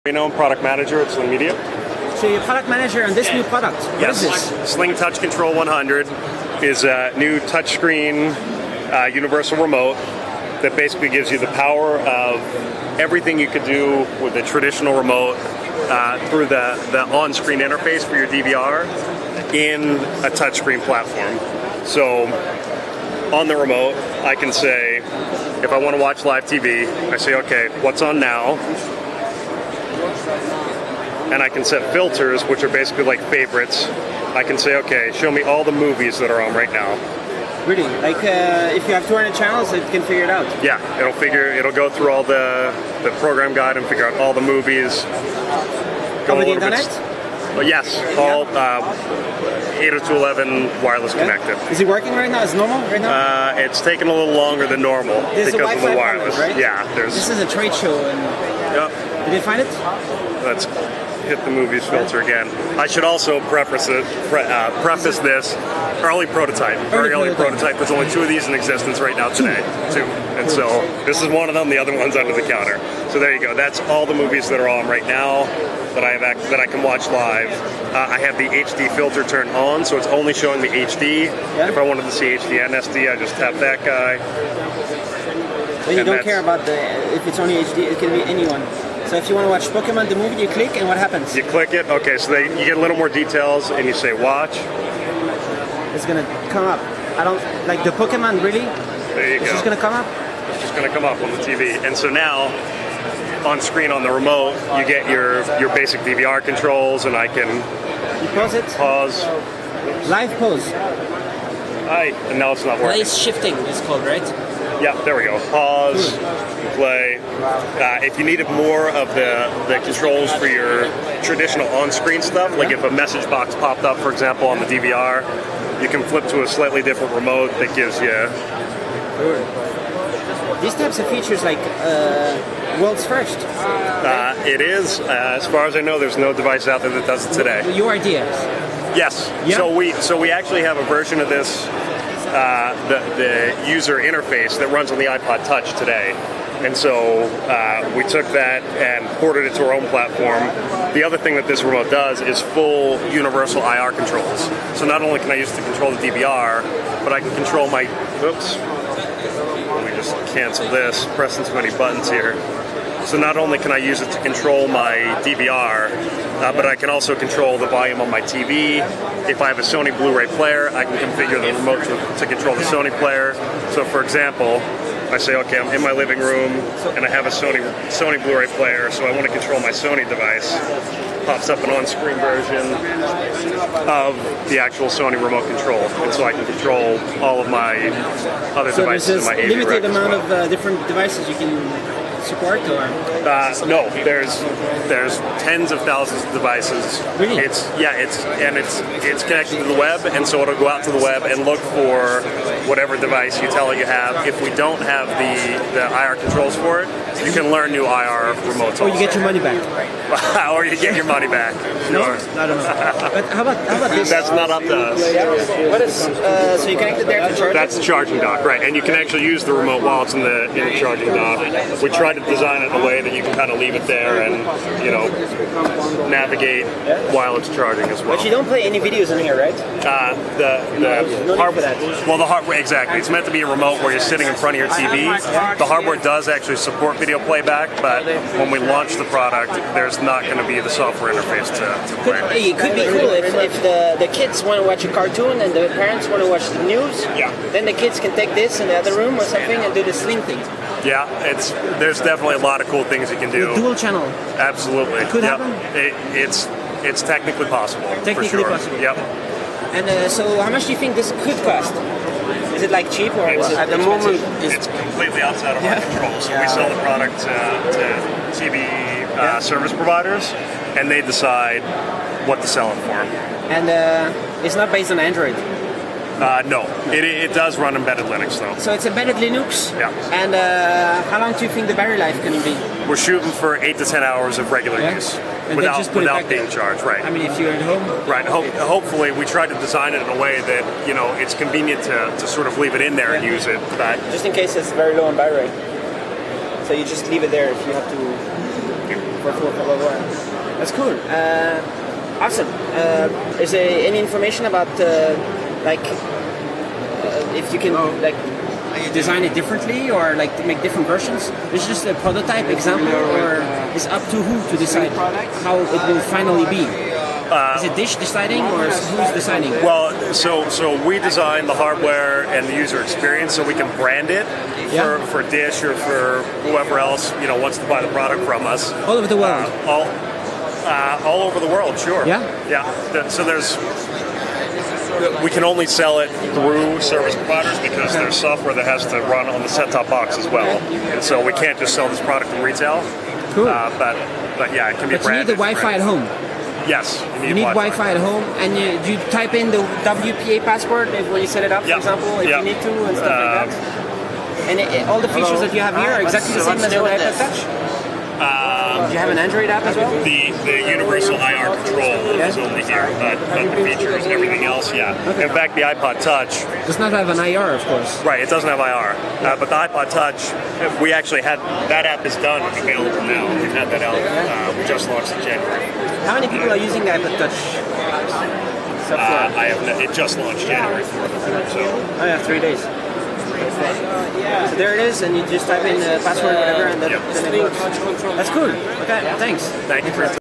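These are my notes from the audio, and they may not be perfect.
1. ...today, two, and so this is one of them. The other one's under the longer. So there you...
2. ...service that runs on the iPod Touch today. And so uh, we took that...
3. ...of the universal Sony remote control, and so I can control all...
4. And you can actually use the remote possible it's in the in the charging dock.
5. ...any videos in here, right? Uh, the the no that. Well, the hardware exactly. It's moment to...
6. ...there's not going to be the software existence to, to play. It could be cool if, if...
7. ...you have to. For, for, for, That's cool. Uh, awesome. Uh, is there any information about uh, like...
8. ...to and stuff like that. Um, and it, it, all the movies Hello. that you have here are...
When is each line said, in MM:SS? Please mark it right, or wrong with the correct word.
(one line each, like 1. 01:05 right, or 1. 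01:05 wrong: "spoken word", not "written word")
1. 01:09 wrong: "counter", not "longer"
2. 02:23 wrong: "interface", not "service"
3. 03:03 wrong: "actual", not "universal"
4. 03:38 wrong: "while", not "possible"
5. 03:48 wrong: "meant", not "moment"
6. 03:59 wrong: "interface", not "existence"
7. 04:57 right
8. 05:52 wrong: "features", not "movies".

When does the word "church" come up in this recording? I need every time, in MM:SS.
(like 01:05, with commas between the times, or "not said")
not said.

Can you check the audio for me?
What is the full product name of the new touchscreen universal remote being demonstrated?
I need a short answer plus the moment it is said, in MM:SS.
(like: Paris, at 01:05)
Sling Touch Control 100, at 00:04.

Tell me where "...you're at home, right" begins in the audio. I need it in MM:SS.
04:47.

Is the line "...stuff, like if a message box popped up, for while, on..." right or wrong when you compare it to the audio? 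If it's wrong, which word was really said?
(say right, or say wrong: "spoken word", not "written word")
wrong: "example", not "while".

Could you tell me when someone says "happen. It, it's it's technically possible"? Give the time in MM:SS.
04:15.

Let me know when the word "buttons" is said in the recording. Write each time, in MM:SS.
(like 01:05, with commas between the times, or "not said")
02:41.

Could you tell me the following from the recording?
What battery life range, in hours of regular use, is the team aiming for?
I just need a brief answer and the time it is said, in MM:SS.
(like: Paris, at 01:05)
8 to 10 hours, at 04:43.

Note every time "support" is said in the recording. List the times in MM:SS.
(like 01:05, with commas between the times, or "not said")
03:12, 03:56.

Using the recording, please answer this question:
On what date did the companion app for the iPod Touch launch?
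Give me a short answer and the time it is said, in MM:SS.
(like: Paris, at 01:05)
January 4th, at 06:20.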